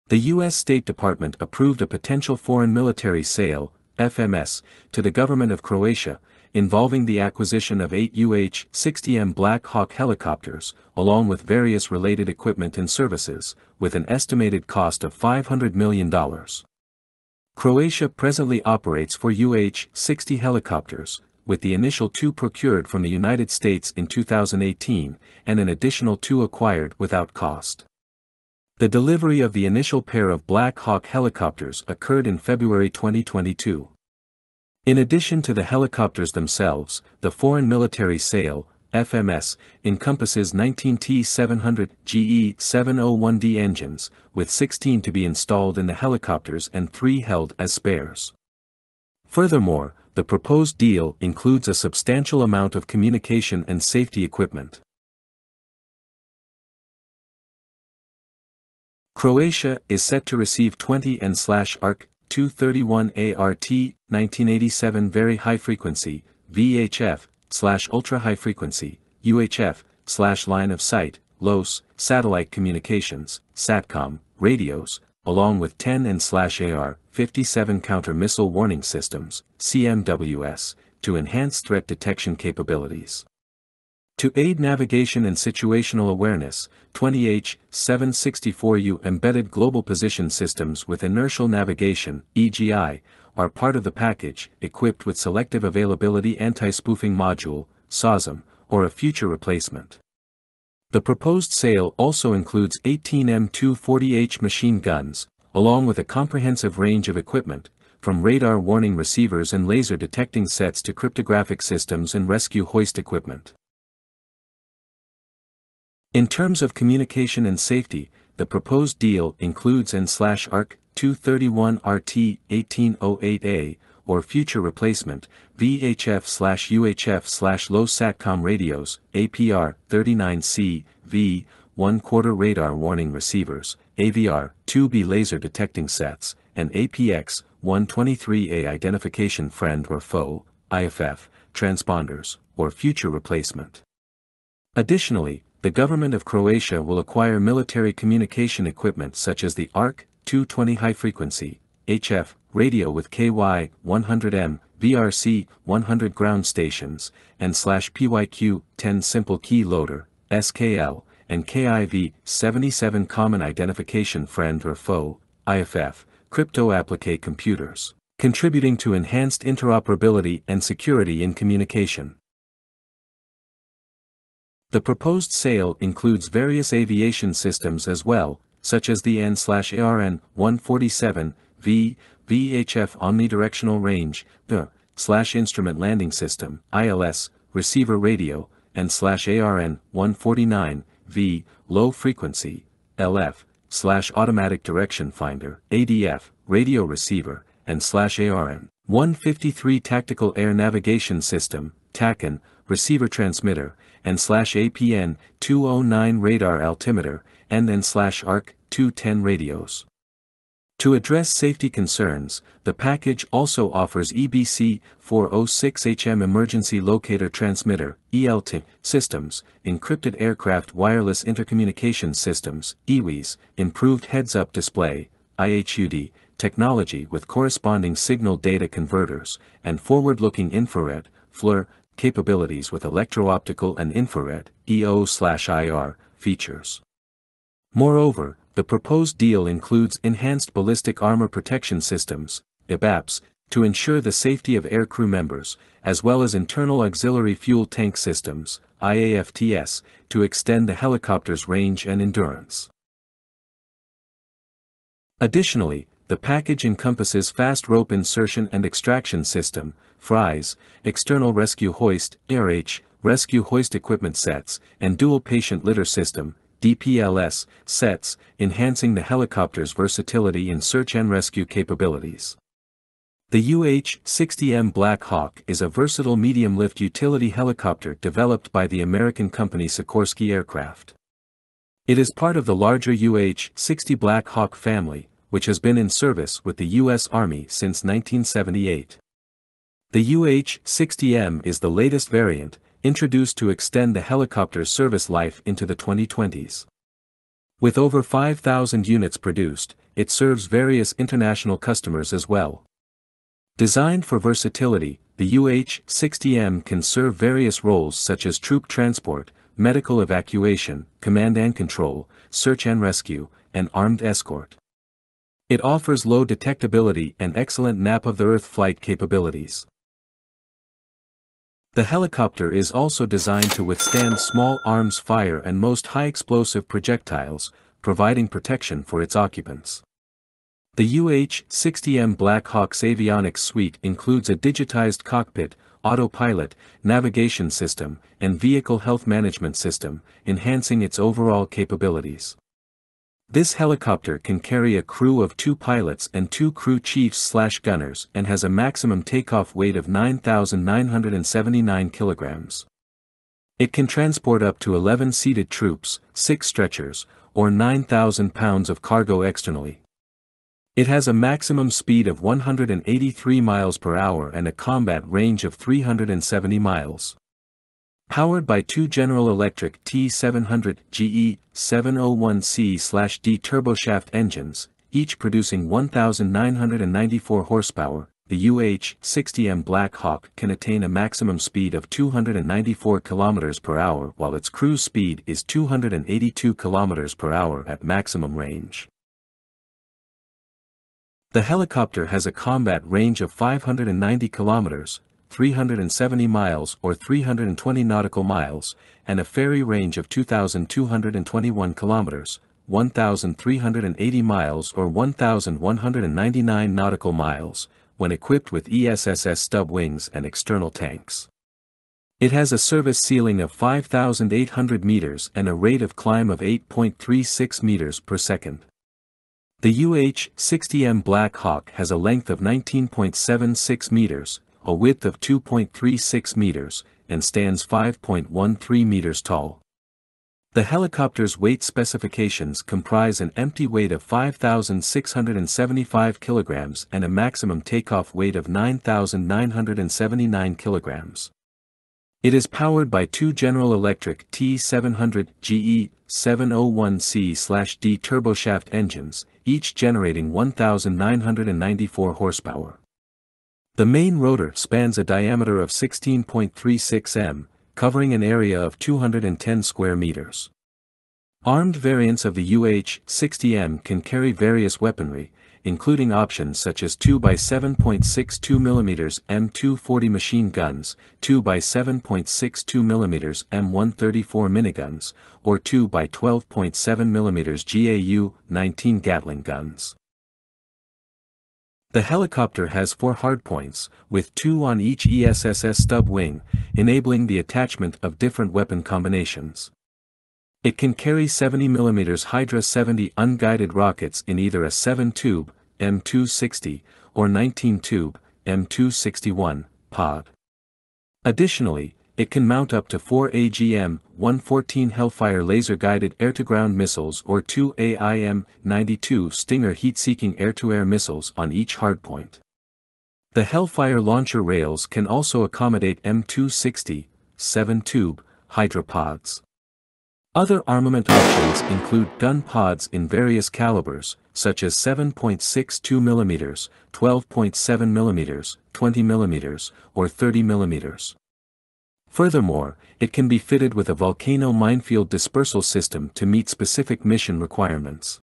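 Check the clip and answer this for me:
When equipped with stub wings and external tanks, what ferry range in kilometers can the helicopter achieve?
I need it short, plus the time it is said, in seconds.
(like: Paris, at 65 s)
2,221 km, at 400 s.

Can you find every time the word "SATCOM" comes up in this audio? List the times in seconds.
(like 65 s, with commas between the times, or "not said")
73 s, 127 s.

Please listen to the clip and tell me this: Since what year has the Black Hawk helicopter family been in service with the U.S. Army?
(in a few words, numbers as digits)
1978.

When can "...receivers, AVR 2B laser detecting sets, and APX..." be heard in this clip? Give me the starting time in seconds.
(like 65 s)
133 s.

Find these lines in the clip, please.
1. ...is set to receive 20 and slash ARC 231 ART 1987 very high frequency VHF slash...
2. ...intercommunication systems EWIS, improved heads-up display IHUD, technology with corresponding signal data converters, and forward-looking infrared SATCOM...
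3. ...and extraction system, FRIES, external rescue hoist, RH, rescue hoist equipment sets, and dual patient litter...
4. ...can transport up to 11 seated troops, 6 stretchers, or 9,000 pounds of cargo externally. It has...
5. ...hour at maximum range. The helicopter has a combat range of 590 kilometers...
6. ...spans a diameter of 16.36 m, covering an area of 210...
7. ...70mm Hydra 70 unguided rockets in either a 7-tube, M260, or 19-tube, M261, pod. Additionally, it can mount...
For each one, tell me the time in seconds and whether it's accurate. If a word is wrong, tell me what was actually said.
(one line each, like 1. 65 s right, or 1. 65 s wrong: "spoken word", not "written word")
1. 59 s right
2. 221 s wrong: "FLIR", not "SATCOM"
3. 258 s right
4. 353 s right
5. 387 s right
6. 454 s right
7. 491 s right.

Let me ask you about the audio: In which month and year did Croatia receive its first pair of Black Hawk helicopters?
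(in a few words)
February 2022.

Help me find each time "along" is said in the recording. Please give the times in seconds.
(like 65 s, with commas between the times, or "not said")
10 s, 75 s, 105 s.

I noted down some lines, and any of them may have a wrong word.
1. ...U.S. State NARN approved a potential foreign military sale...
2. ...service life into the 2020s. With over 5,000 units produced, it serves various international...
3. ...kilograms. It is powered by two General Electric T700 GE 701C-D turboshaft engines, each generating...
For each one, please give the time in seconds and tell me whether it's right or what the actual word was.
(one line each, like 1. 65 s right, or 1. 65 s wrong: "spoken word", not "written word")
1. 0 s wrong: "Department", not "NARN"
2. 294 s right
3. 440 s right.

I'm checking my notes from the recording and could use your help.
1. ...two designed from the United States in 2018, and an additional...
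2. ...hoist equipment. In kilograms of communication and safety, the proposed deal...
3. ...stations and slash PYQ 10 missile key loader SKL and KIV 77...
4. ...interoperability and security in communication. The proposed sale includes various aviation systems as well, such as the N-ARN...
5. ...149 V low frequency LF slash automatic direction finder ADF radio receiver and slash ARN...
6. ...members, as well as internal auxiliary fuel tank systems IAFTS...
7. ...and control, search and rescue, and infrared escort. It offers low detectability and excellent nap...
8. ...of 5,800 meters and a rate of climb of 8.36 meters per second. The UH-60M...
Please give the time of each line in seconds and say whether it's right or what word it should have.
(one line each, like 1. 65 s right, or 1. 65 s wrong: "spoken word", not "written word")
1. 22 s wrong: "procured", not "designed"
2. 112 s wrong: "terms", not "kilograms"
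3. 156 s wrong: "simple", not "missile"
4. 169 s right
5. 189 s right
6. 245 s right
7. 311 s wrong: "armed", not "infrared"
8. 413 s right.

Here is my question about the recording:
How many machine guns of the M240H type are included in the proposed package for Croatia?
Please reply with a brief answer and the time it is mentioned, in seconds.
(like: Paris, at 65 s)
18, at 102 s.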